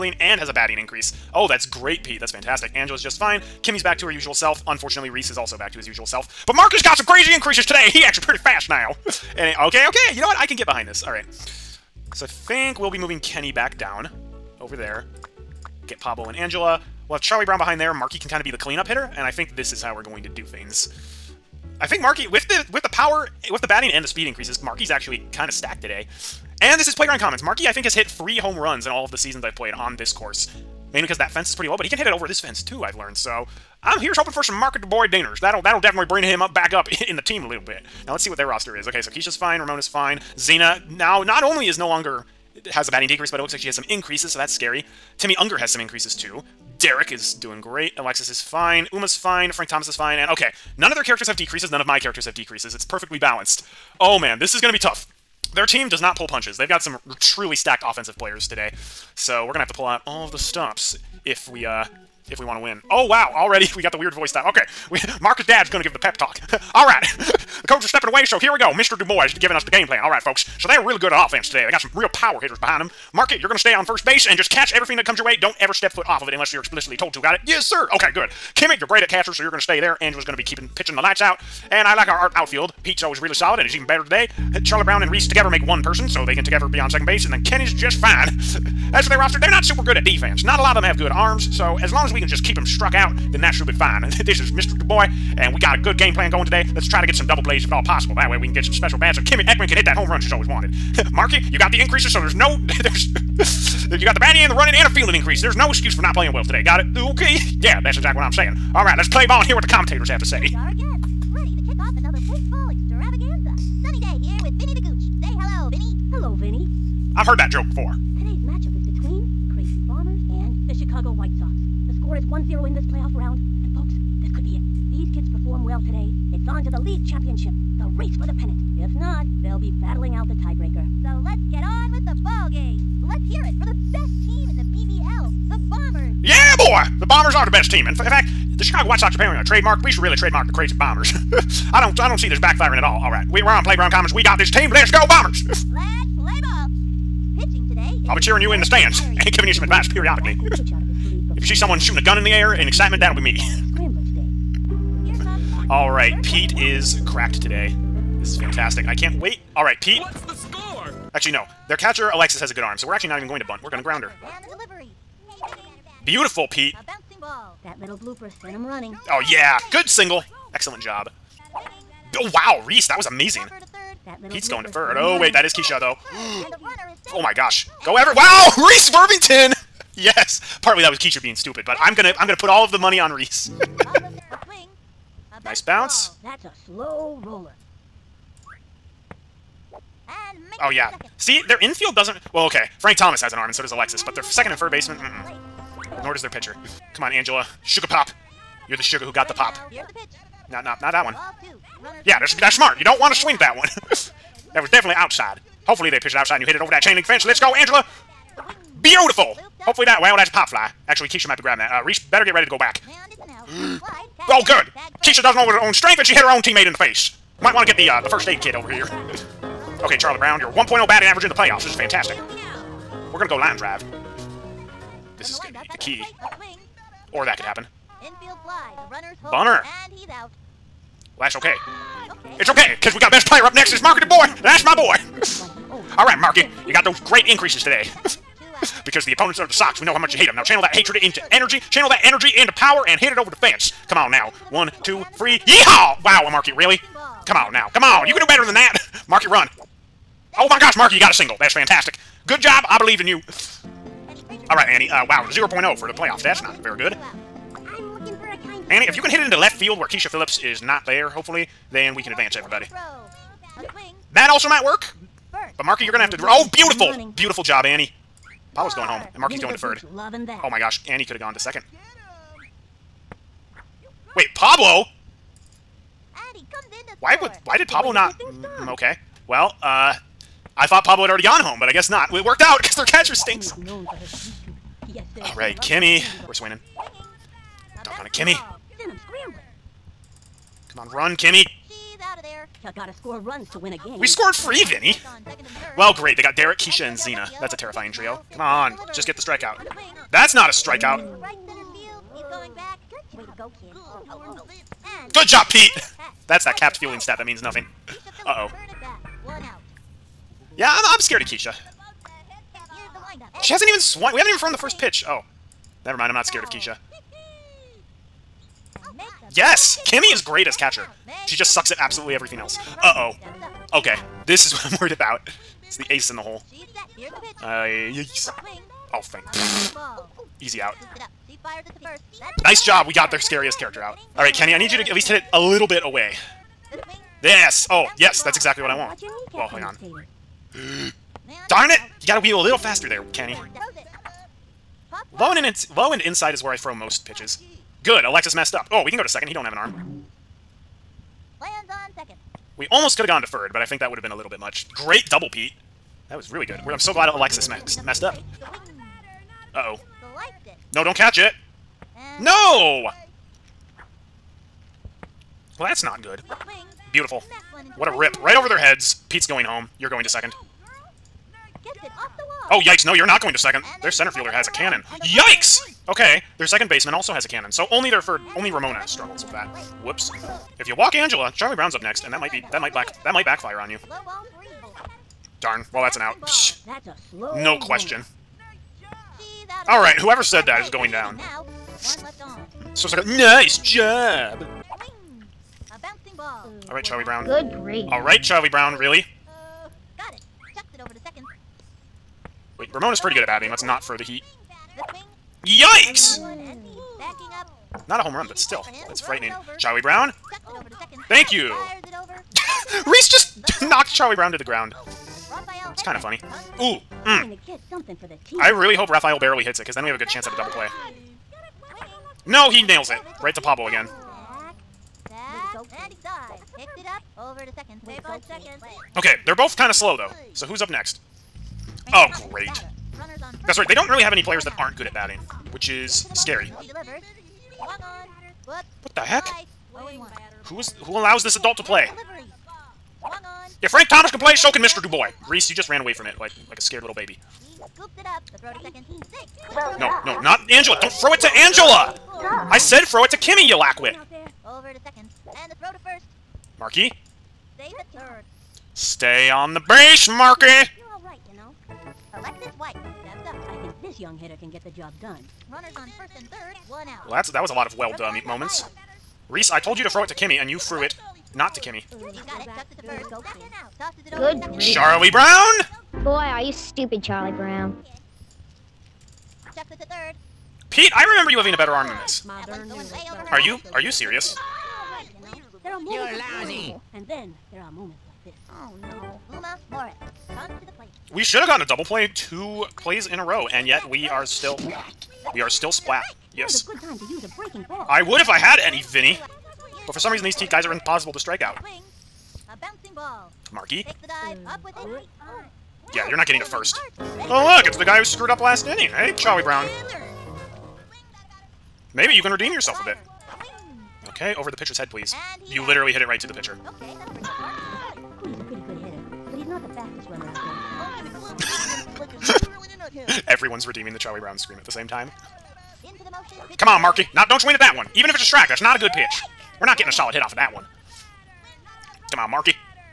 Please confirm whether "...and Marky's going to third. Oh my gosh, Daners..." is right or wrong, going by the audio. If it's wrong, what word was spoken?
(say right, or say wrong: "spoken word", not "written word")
wrong: "Annie", not "Daners".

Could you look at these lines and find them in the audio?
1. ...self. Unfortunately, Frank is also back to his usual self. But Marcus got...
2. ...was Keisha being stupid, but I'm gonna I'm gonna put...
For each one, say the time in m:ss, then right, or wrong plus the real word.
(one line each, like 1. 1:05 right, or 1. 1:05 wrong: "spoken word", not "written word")
1. 0:04 wrong: "Reese", not "Frank"
2. 3:00 right.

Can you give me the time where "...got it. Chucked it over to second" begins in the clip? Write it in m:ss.
6:39.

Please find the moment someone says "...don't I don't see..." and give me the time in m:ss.
2:21.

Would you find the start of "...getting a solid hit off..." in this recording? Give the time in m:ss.
8:49.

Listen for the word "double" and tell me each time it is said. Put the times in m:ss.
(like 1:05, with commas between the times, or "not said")
1:37, 5:55, 7:00, 8:11.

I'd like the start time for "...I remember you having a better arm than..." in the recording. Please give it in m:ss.
8:00.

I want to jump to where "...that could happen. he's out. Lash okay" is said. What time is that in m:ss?
3:47.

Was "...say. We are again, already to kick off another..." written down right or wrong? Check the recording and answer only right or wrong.
wrong.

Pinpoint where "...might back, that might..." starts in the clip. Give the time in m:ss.
6:22.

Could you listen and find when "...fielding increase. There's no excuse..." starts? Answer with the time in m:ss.
1:44.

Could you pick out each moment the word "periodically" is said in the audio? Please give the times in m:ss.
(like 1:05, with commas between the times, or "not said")
2:29.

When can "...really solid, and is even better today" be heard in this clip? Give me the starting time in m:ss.
1:23.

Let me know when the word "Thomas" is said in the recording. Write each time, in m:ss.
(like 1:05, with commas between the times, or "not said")
0:49, 3:12, 7:23.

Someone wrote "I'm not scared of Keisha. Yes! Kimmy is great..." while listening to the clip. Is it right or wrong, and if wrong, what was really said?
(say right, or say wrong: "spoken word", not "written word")
right.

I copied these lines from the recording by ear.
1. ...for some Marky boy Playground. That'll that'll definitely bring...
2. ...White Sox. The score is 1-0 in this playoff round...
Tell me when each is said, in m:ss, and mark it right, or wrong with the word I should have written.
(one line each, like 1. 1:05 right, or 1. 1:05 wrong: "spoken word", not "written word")
1. 0:34 wrong: "Daners", not "Playground"
2. 2:01 right.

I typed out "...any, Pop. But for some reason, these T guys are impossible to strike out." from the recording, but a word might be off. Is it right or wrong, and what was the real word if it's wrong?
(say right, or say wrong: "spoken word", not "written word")
wrong: "Vinny", not "Pop".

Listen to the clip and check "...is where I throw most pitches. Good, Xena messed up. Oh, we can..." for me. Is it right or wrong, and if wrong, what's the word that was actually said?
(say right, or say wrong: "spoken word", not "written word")
wrong: "Alexis", not "Xena".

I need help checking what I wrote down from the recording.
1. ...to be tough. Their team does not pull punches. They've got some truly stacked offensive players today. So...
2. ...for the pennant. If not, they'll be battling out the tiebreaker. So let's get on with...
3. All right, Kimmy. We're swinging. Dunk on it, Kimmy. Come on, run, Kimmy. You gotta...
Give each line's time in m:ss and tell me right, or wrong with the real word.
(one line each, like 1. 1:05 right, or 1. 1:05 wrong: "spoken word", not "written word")
1. 0:54 right
2. 2:08 right
3. 4:43 right.